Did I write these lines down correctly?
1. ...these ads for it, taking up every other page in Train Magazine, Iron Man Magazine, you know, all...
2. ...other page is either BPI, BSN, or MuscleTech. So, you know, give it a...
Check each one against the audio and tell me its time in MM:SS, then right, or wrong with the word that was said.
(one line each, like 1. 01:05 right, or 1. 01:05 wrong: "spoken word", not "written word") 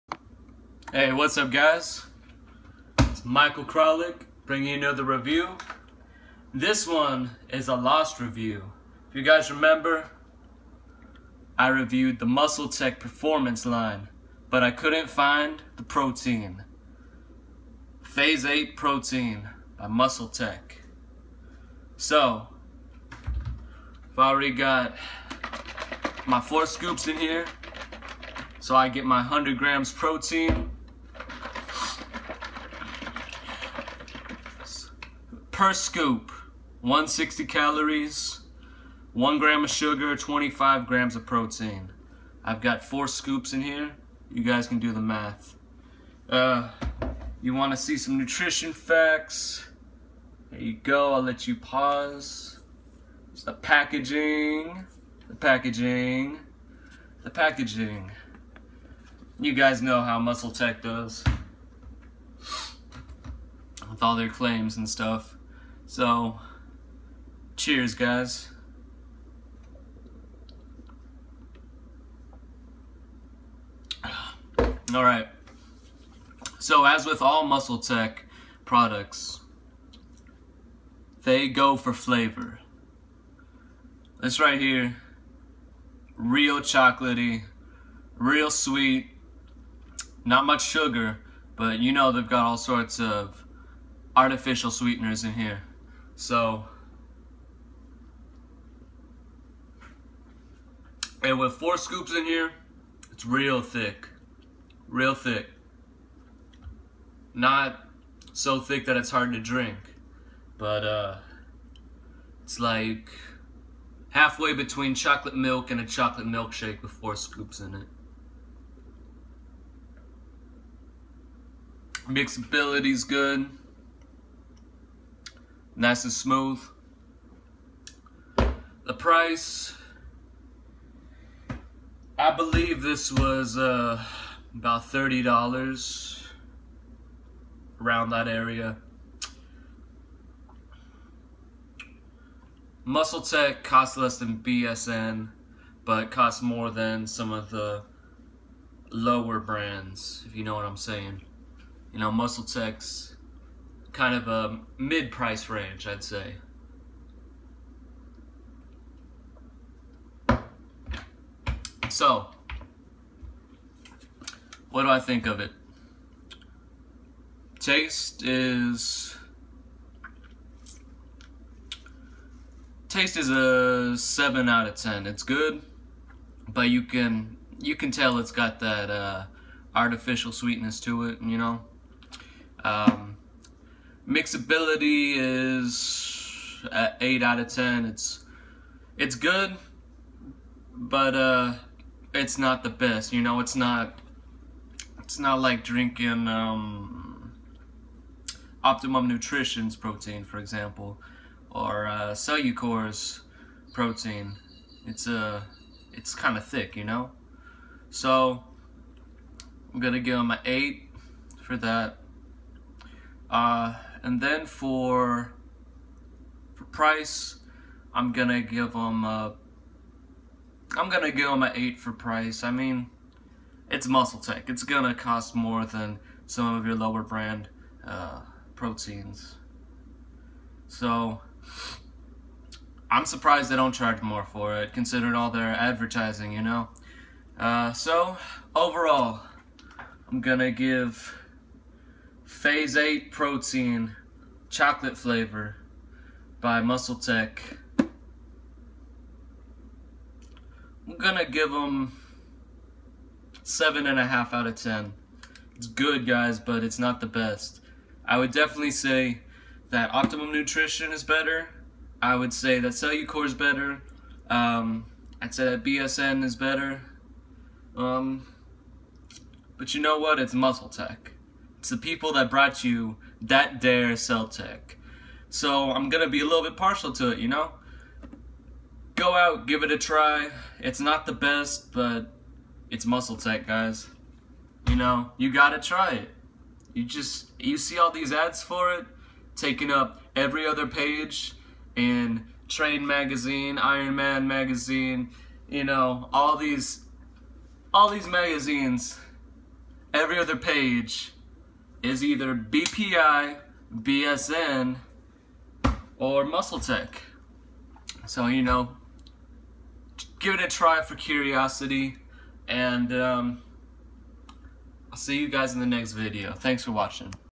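1. 04:47 right
2. 05:00 right.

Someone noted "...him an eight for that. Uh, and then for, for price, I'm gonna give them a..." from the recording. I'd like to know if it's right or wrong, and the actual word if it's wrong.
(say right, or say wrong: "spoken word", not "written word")
right.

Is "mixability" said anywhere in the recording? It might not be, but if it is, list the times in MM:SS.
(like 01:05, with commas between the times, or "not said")
02:02, 03:04.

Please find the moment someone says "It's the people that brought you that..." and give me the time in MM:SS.
04:31.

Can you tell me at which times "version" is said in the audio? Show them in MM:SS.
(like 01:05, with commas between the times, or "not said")
not said.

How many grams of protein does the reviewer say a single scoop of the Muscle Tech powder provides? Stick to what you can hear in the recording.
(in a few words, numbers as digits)
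25 grams.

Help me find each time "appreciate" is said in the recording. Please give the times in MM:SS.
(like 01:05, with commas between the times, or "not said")
not said.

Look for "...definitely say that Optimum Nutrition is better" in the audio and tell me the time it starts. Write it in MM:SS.
04:18.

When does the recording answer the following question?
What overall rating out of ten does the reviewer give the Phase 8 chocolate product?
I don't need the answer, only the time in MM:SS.
04:13.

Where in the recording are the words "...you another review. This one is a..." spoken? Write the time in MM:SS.
00:04.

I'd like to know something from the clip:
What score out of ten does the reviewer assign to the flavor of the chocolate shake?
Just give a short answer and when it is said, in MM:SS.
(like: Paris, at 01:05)
7, at 02:53.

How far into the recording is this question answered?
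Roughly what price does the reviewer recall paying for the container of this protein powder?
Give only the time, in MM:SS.
02:14.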